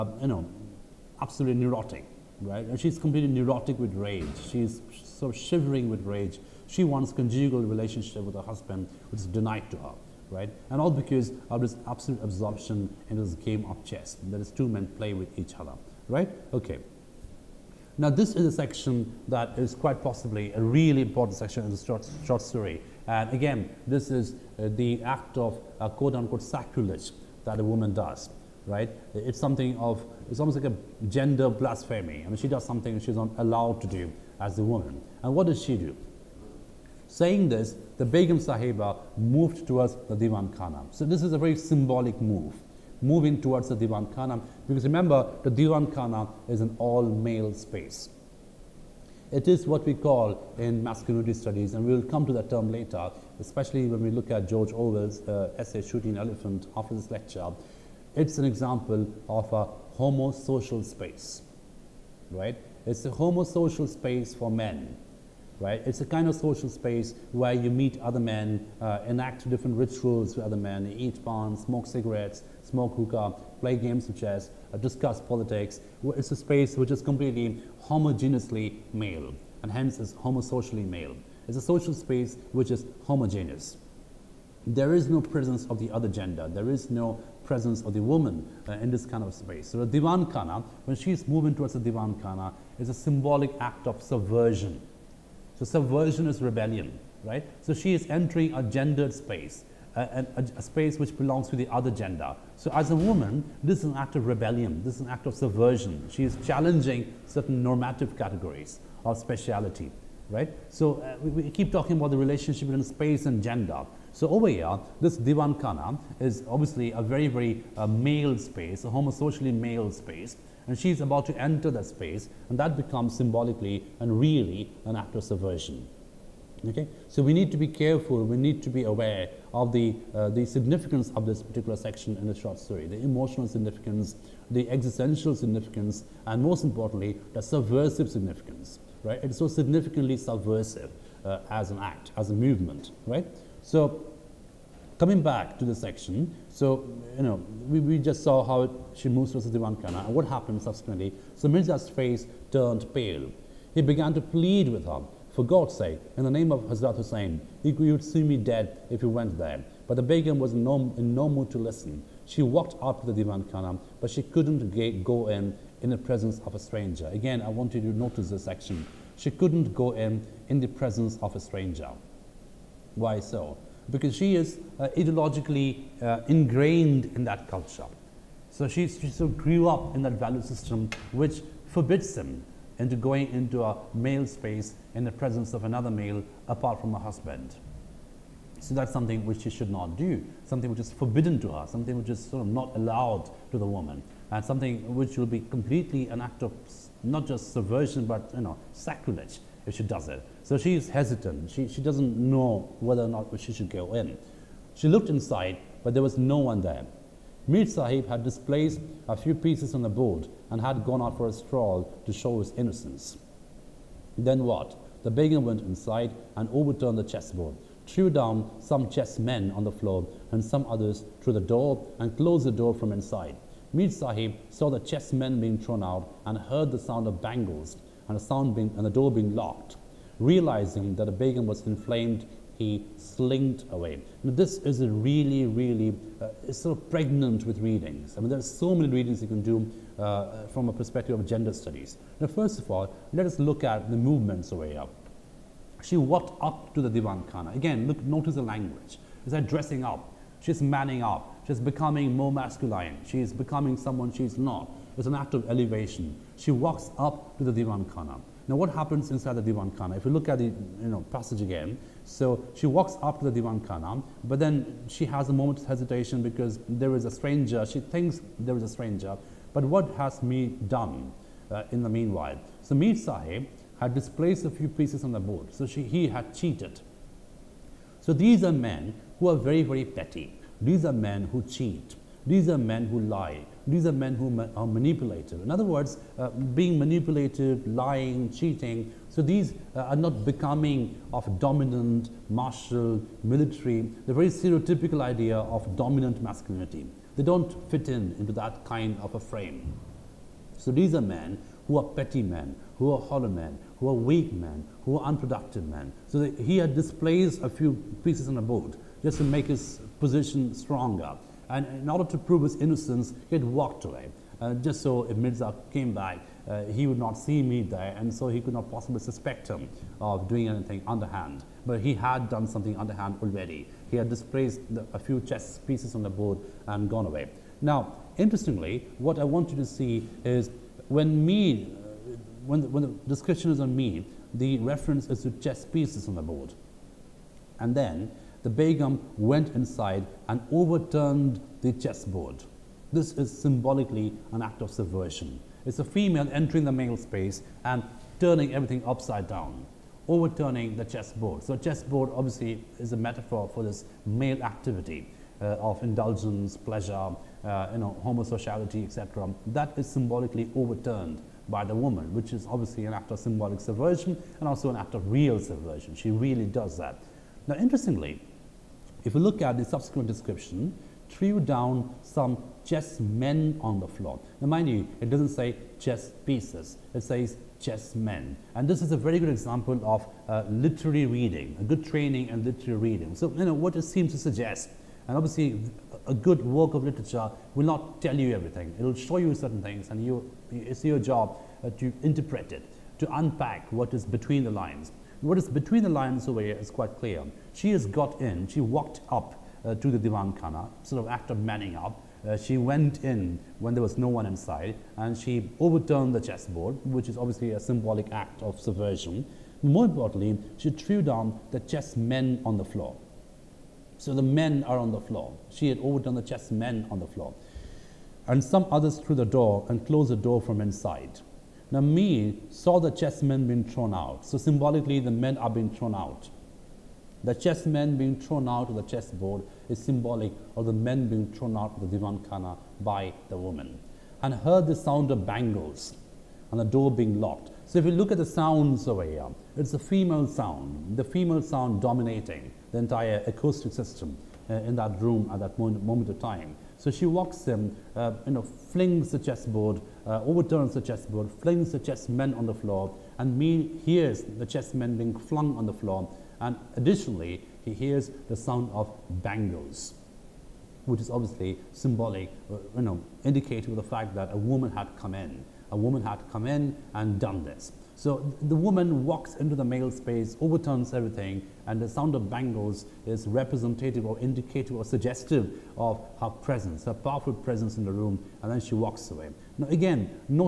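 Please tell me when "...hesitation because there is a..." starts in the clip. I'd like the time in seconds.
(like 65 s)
265 s.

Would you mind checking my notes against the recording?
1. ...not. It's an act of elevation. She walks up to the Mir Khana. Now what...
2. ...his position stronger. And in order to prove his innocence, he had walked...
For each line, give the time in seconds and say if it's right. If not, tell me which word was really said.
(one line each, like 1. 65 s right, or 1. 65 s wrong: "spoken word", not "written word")
1. 254 s wrong: "Divan", not "Mir"
2. 309 s right.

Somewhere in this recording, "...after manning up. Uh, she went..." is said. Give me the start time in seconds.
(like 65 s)
401 s.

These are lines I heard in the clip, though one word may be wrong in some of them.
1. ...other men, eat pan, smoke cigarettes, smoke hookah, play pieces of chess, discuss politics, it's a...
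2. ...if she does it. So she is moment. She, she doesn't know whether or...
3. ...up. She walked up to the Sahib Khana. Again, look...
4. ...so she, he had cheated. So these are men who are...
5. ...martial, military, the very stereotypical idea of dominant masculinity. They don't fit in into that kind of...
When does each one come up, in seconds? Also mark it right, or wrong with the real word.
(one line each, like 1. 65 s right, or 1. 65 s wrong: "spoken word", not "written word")
1. 70 s wrong: "games", not "pieces"
2. 199 s wrong: "hesitant", not "moment"
3. 244 s wrong: "Divan", not "Sahib"
4. 275 s right
5. 292 s right.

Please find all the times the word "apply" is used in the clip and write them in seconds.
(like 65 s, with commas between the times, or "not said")
not said.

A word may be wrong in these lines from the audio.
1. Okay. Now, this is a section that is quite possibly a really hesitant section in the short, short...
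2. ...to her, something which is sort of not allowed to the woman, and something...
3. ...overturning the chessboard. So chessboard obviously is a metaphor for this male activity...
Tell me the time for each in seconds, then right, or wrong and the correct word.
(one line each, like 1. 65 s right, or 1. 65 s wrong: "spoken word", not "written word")
1. 16 s wrong: "important", not "hesitant"
2. 191 s right
3. 350 s right.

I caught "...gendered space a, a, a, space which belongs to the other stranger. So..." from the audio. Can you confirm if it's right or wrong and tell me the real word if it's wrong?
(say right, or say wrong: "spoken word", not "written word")
wrong: "gender", not "stranger".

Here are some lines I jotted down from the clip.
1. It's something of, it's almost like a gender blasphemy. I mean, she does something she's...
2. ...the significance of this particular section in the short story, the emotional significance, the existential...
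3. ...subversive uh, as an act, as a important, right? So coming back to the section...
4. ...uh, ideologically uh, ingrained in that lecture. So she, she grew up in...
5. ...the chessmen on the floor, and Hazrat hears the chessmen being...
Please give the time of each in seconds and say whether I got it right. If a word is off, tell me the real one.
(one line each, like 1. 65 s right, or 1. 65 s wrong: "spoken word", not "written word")
1. 29 s right
2. 130 s right
3. 140 s wrong: "movement", not "important"
4. 174 s wrong: "culture", not "lecture"
5. 451 s wrong: "Mir", not "Hazrat".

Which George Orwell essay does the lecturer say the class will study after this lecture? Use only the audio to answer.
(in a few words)
Shooting Elephant.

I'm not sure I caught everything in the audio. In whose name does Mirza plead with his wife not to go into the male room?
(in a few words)
Hazrat Hussein.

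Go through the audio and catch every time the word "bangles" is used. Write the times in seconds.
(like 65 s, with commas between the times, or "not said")
227 s, 435 s, 459 s, 472 s.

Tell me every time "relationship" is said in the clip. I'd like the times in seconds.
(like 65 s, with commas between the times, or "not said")
7 s, 112 s.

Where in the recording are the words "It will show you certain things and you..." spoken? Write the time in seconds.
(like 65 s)
388 s.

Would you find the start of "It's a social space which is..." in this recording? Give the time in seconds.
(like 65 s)
81 s.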